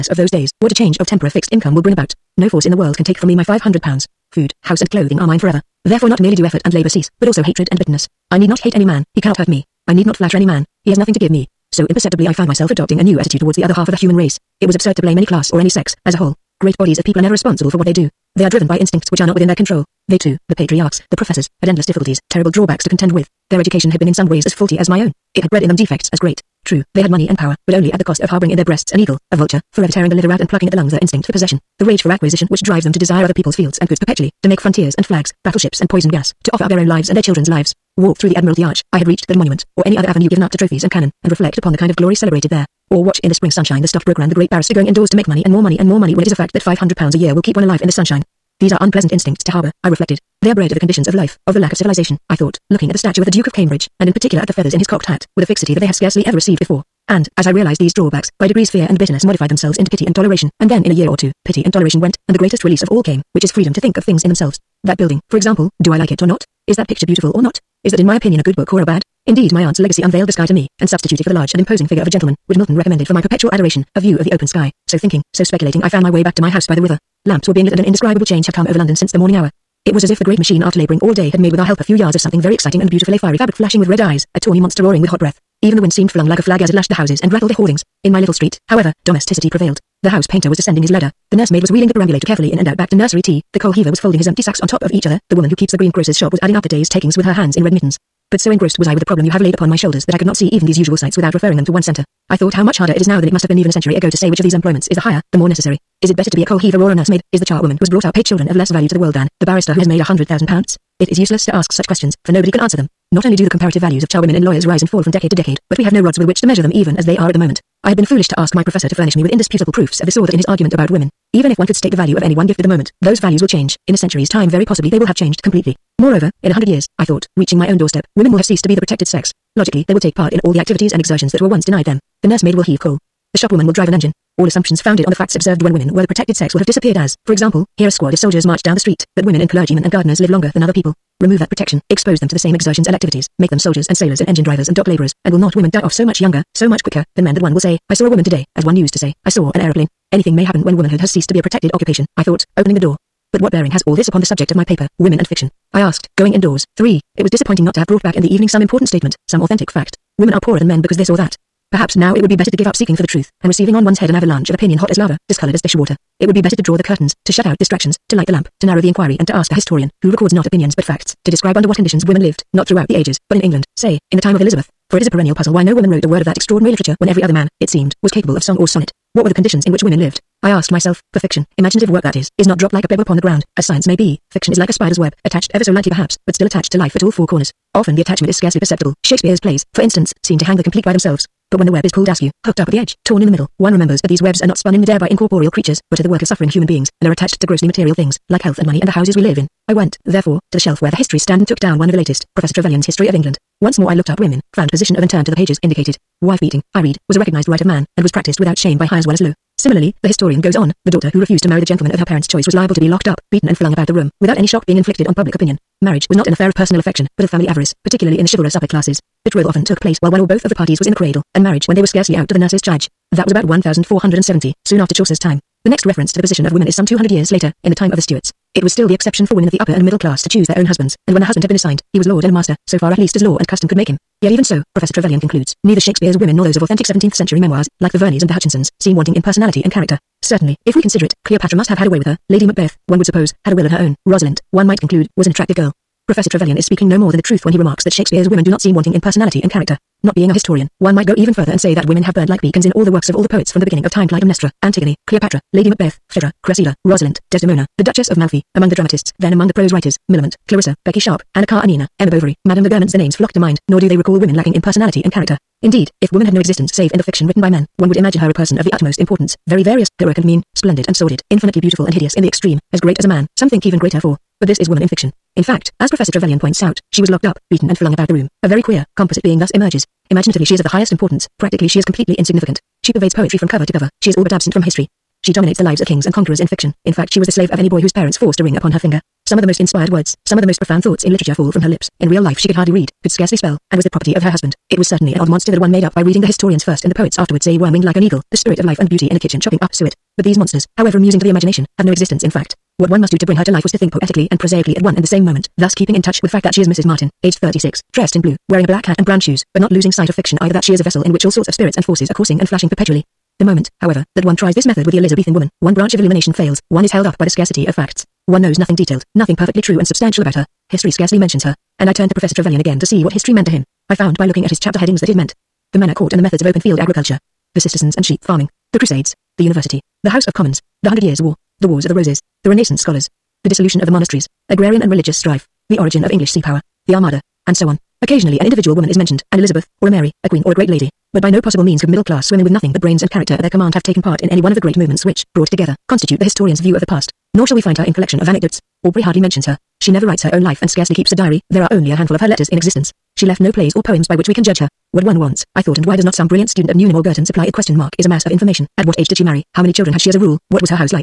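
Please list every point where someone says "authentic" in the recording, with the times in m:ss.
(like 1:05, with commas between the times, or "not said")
2:39, 3:56.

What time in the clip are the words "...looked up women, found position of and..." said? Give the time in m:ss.
3:23.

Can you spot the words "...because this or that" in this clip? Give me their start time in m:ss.
2:40.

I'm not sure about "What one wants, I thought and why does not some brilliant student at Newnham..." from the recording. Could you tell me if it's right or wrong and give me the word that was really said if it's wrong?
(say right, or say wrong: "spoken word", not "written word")
right.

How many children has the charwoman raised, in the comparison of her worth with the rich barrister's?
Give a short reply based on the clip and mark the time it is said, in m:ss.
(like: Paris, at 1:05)
8, at 1:48.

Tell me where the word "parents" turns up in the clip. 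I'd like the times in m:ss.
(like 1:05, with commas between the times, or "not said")
3:32, 4:47.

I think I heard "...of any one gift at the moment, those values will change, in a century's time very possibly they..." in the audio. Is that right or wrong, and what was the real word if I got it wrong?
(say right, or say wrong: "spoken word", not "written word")
right.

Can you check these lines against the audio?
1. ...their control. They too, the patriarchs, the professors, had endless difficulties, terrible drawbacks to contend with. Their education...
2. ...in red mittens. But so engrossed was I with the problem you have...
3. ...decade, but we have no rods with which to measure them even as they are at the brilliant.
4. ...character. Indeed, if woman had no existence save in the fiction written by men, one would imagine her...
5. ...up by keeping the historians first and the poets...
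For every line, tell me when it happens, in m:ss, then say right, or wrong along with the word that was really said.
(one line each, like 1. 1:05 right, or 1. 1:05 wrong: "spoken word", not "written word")
1. 0:19 right
2. 1:37 right
3. 1:55 wrong: "moment", not "brilliant"
4. 4:25 right
5. 4:55 wrong: "reading", not "keeping".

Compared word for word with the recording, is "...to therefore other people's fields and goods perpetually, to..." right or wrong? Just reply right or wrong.
wrong.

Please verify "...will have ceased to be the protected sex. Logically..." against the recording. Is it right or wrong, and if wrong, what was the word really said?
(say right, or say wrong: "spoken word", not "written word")
right.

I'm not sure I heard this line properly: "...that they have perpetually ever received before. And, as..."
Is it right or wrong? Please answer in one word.
wrong.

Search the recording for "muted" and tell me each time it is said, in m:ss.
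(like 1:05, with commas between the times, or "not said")
not said.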